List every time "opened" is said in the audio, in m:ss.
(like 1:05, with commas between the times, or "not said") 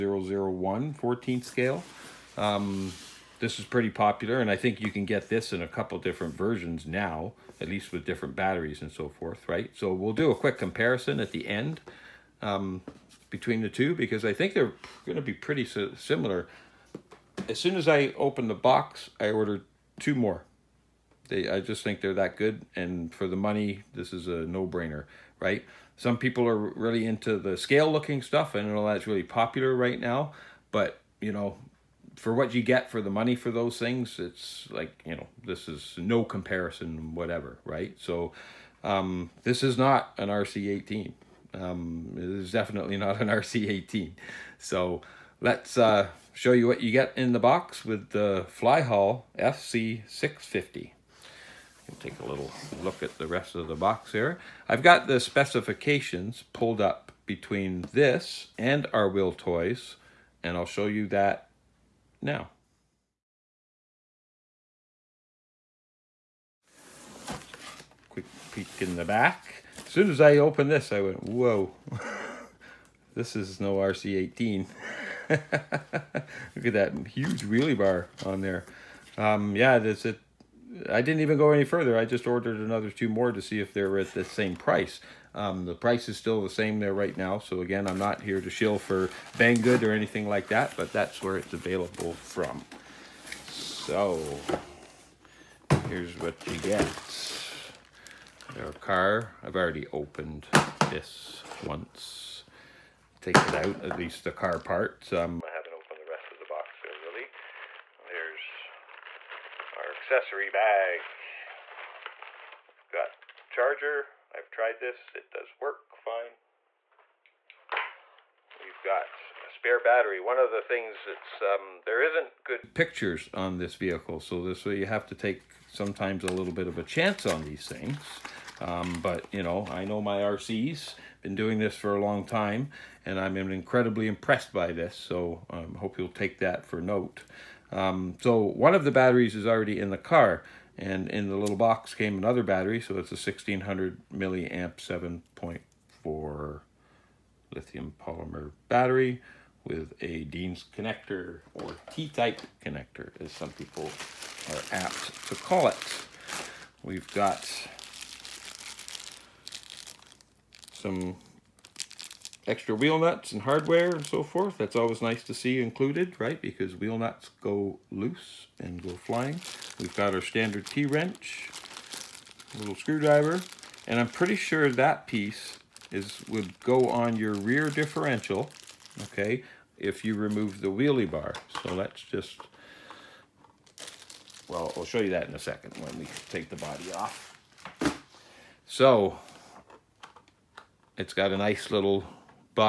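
0:18, 1:10, 1:39, 1:45.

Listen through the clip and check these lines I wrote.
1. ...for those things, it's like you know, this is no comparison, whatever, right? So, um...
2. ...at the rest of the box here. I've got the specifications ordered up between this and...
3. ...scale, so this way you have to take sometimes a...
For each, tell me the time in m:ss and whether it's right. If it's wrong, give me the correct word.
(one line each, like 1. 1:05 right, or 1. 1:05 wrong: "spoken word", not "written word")
1. 0:33 right
2. 0:53 wrong: "pulled", not "ordered"
3. 2:03 wrong: "vehicle", not "scale".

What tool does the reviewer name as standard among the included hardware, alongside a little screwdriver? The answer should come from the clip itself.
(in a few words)
T-wrench.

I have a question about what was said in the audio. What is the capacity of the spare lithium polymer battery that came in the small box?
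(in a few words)
1600 milliamp.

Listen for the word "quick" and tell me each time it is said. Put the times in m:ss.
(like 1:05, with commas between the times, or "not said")
0:10, 1:08.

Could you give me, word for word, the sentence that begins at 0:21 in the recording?
They, I just think they're that good, and for the money, this is a no-brainer, right?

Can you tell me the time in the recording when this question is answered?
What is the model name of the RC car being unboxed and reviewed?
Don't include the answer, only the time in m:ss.
0:48.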